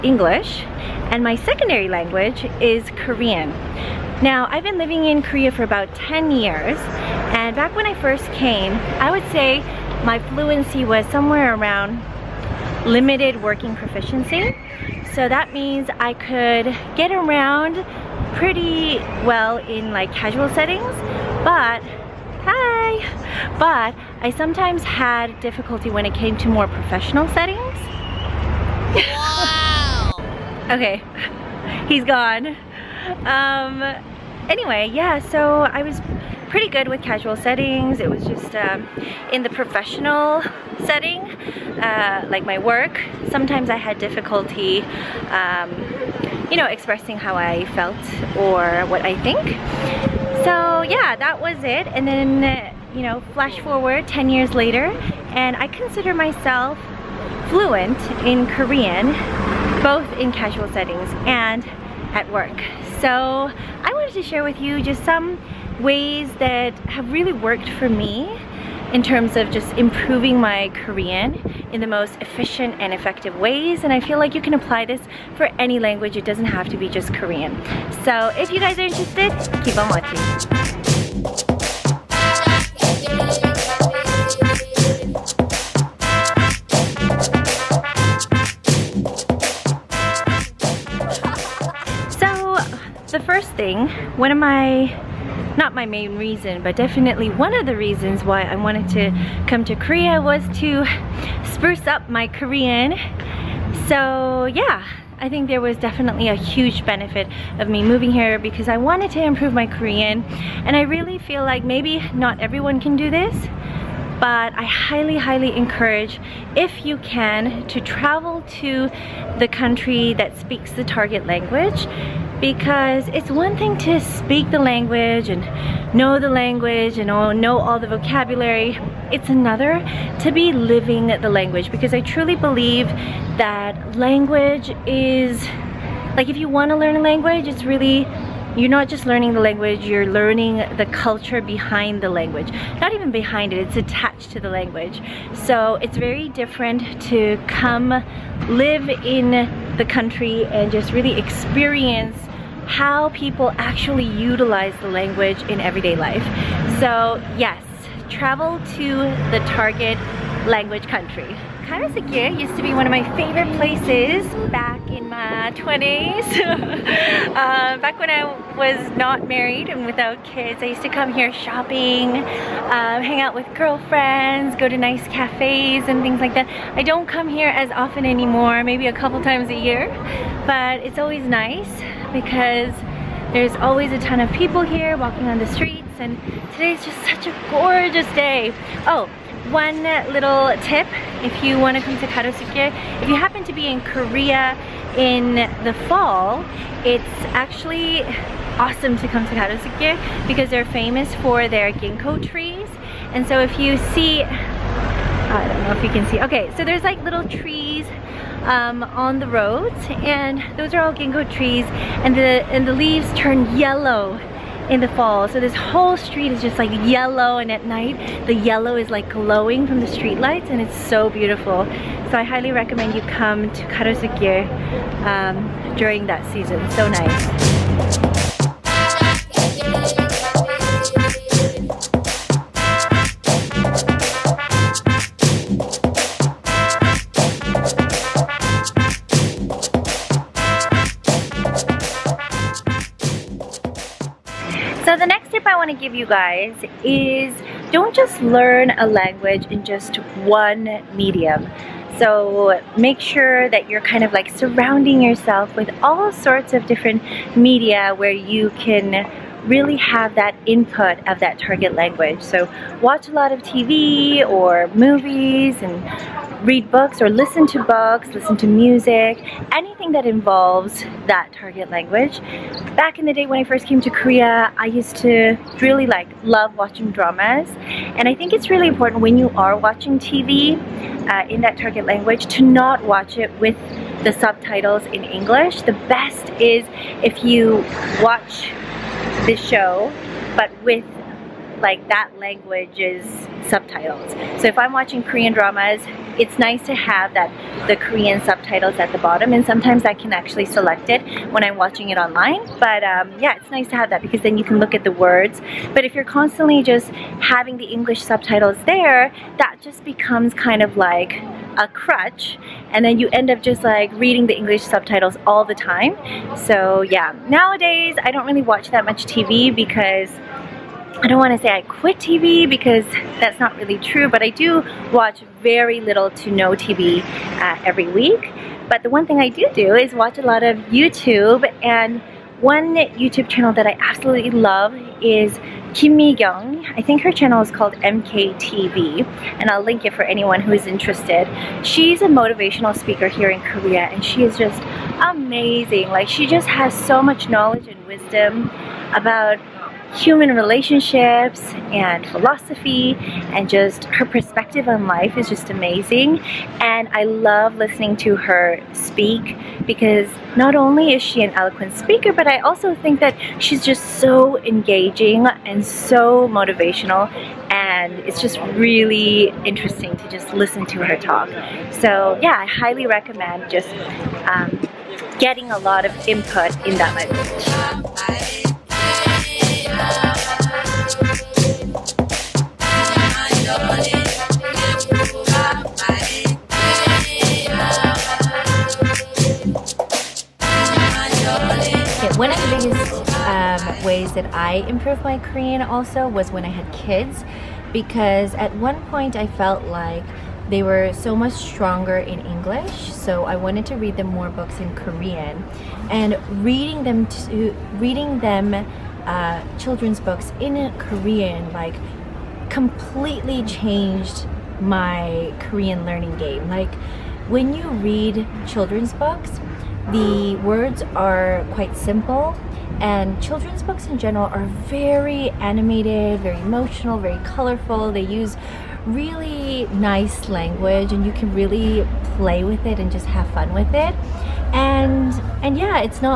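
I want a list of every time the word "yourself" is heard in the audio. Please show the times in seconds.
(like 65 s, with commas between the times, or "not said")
255 s.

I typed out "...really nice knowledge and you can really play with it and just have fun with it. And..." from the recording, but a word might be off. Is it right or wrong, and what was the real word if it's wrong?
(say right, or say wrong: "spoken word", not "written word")
wrong: "language", not "knowledge".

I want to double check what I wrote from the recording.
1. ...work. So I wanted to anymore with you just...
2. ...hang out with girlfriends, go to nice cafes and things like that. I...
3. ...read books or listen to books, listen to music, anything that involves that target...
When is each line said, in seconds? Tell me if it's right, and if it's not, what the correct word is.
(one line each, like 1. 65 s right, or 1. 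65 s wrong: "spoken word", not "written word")
1. 62 s wrong: "share", not "anymore"
2. 173 s right
3. 266 s right.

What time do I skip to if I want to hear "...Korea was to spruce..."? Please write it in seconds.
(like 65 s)
99 s.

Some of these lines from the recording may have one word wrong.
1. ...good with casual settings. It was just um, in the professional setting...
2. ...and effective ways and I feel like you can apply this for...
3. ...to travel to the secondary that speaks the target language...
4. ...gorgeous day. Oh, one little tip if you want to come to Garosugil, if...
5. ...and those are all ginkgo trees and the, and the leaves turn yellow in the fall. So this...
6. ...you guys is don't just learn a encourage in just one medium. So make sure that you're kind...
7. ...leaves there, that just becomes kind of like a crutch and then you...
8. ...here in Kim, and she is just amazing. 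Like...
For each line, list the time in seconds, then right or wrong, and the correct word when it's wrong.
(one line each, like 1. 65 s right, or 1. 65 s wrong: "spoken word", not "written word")
1. 36 s right
2. 72 s right
3. 117 s wrong: "country", not "secondary"
4. 187 s right
5. 209 s right
6. 245 s wrong: "language", not "encourage"
7. 308 s wrong: "subtitles", not "leaves"
8. 343 s wrong: "Korea", not "Kim".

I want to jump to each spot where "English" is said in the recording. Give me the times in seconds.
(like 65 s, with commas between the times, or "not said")
0 s, 285 s, 307 s, 314 s, 402 s.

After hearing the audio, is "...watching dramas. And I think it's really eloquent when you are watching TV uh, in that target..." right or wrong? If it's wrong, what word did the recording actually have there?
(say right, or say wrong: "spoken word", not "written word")
wrong: "important", not "eloquent".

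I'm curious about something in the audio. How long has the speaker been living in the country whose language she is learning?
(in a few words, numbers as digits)
10 years.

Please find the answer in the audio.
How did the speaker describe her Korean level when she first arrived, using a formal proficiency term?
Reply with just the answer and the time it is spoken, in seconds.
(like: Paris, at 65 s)
limited working proficiency, at 12 s.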